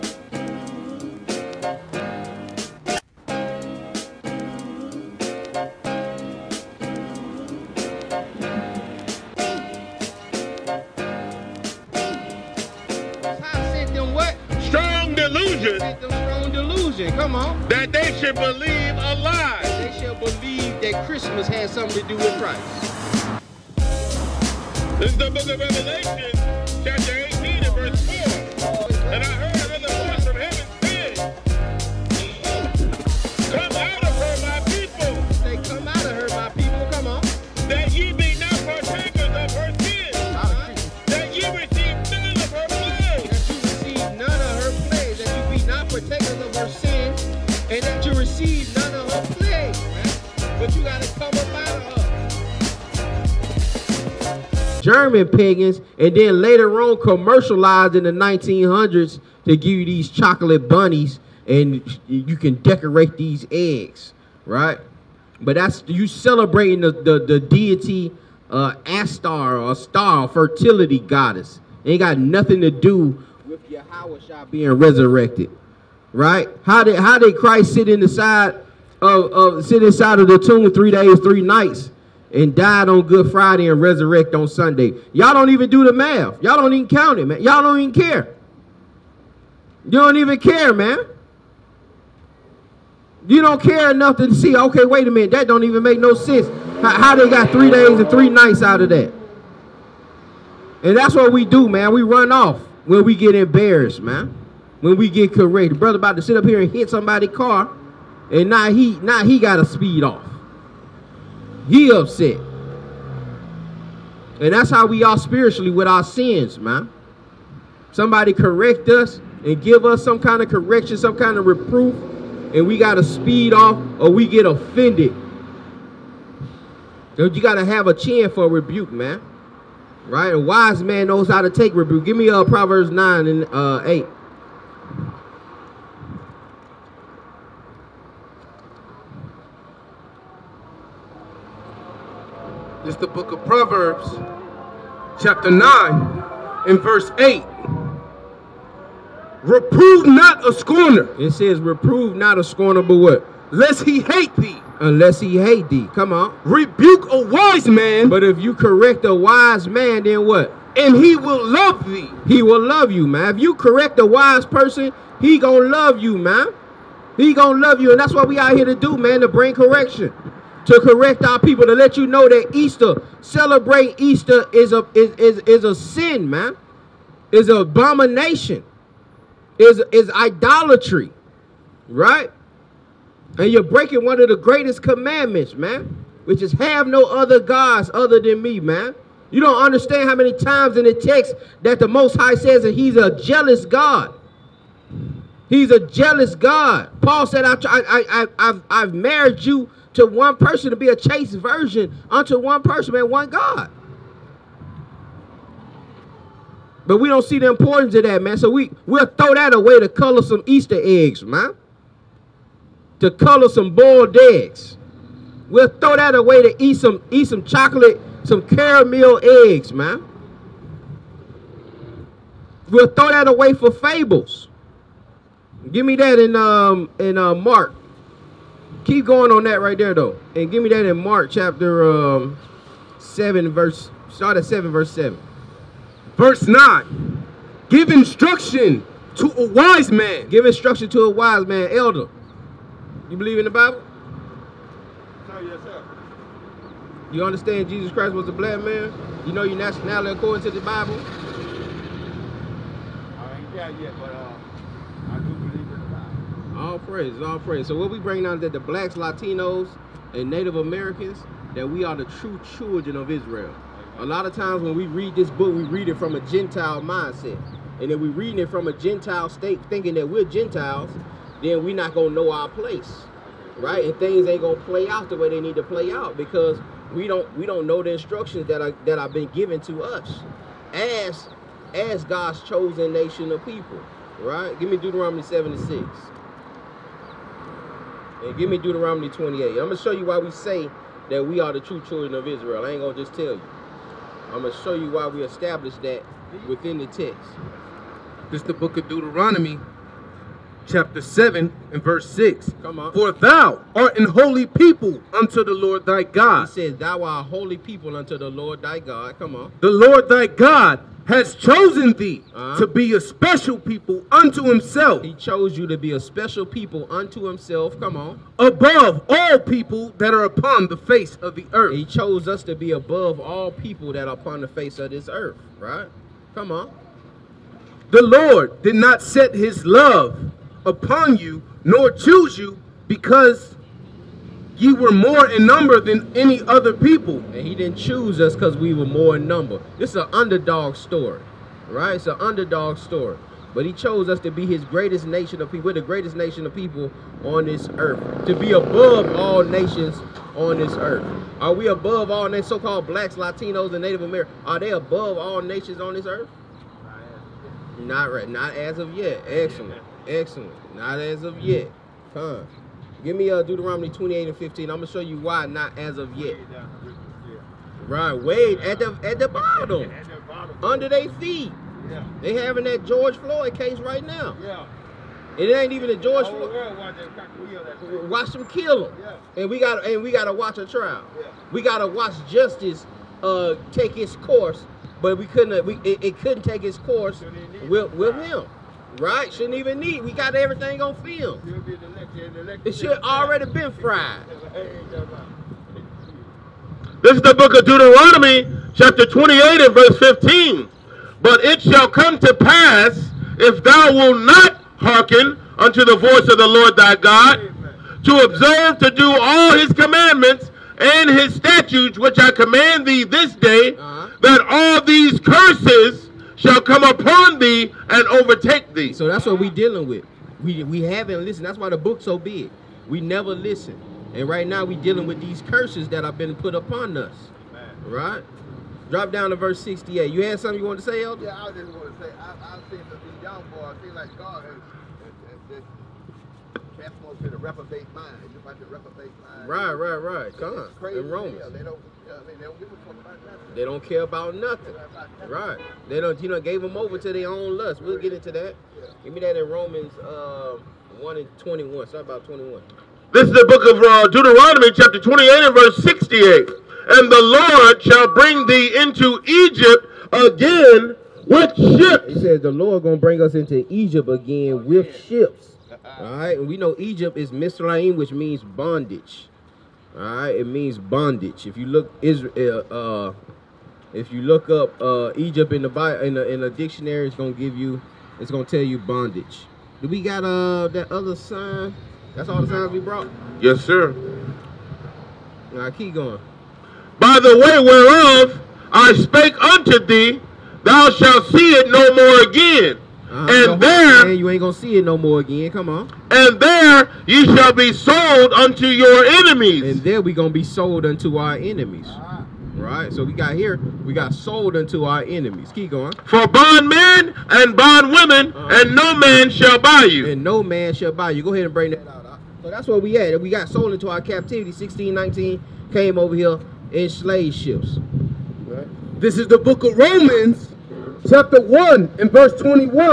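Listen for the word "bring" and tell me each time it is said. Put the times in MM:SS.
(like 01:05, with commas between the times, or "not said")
02:49, 04:18, 07:38, 07:43, 08:31.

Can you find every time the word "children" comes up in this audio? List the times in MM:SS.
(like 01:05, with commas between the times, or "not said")
04:22, 04:51.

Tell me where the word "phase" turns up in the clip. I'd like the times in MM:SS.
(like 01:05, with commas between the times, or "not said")
not said.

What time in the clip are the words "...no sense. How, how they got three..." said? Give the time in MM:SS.
01:35.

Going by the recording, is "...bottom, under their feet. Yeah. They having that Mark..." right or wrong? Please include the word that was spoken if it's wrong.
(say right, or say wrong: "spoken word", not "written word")
wrong: "George", not "Mark".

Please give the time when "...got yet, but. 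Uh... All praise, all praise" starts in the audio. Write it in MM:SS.
04:13.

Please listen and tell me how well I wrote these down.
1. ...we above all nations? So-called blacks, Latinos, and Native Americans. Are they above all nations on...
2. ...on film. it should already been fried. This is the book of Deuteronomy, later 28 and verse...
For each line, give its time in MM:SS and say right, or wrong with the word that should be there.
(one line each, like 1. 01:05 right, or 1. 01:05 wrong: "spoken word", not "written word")
1. 05:51 right
2. 06:30 wrong: "chapter", not "later".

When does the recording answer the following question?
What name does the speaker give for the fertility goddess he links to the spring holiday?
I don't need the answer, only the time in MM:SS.
01:08.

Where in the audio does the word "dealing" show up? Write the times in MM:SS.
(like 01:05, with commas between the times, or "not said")
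06:59, 07:04.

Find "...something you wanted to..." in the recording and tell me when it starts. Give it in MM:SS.
07:10.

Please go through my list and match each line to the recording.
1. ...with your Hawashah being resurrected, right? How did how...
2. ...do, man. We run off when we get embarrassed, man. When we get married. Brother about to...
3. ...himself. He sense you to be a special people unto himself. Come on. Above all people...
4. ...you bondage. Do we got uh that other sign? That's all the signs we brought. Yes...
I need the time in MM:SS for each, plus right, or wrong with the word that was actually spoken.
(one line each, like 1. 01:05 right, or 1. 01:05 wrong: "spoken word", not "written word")
1. 01:13 right
2. 01:41 wrong: "corrected", not "married"
3. 05:14 wrong: "chose", not "sense"
4. 07:58 right.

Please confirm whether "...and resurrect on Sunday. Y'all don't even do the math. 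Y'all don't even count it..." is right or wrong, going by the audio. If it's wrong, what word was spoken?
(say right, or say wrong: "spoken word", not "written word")
right.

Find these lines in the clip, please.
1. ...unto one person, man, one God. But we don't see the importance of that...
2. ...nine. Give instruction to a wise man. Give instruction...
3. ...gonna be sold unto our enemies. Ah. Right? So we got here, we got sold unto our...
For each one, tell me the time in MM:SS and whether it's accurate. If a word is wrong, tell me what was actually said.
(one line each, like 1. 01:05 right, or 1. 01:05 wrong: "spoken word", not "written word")
1. 03:22 right
2. 03:56 right
3. 08:20 right.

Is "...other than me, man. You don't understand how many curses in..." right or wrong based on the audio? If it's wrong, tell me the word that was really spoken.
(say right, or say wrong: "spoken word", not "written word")
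wrong: "times", not "curses".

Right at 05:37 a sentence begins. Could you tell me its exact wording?
And he didn't choose us because we were more in number.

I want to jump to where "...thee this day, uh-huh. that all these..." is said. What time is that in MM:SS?
06:52.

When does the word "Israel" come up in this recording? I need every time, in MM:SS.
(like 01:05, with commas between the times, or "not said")
04:23, 04:52, 07:52.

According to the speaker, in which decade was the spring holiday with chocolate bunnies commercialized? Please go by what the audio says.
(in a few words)
1900s.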